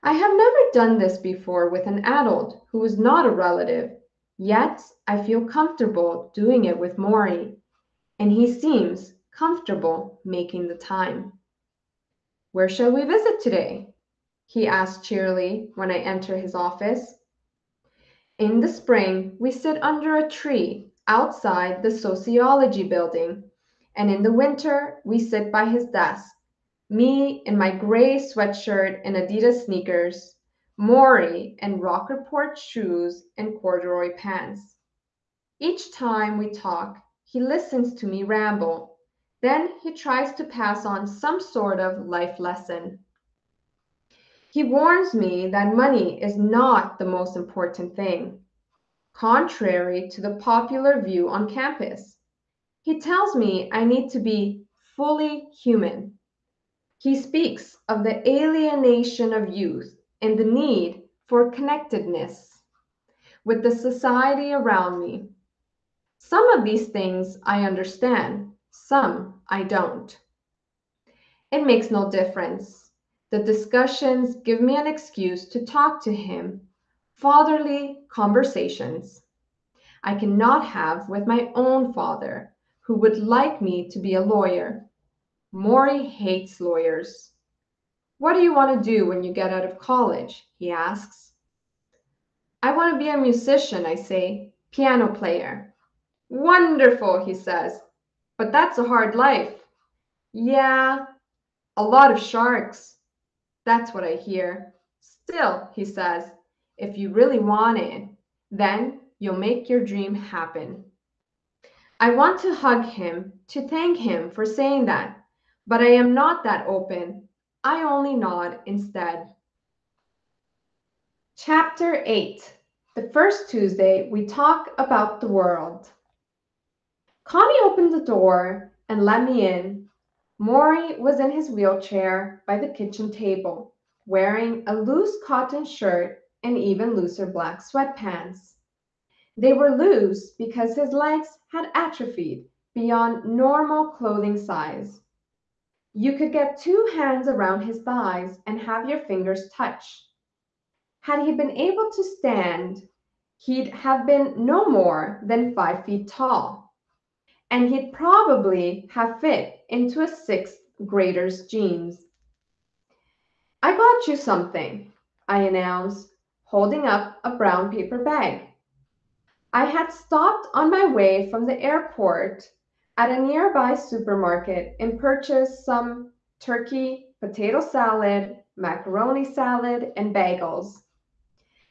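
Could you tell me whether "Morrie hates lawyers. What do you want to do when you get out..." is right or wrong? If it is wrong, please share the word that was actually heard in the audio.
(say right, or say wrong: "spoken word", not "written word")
right.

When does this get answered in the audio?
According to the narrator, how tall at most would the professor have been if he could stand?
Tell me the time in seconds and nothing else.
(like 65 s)
155 s.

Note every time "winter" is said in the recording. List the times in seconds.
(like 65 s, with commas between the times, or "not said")
24 s.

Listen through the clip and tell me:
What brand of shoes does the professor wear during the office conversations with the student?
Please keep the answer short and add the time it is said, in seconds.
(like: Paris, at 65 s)
Rockport, at 31 s.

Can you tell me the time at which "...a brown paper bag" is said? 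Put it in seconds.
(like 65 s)
167 s.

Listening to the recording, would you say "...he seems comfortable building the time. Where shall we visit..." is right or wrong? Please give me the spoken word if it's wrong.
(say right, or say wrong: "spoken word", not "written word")
wrong: "making", not "building".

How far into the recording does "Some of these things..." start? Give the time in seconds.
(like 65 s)
66 s.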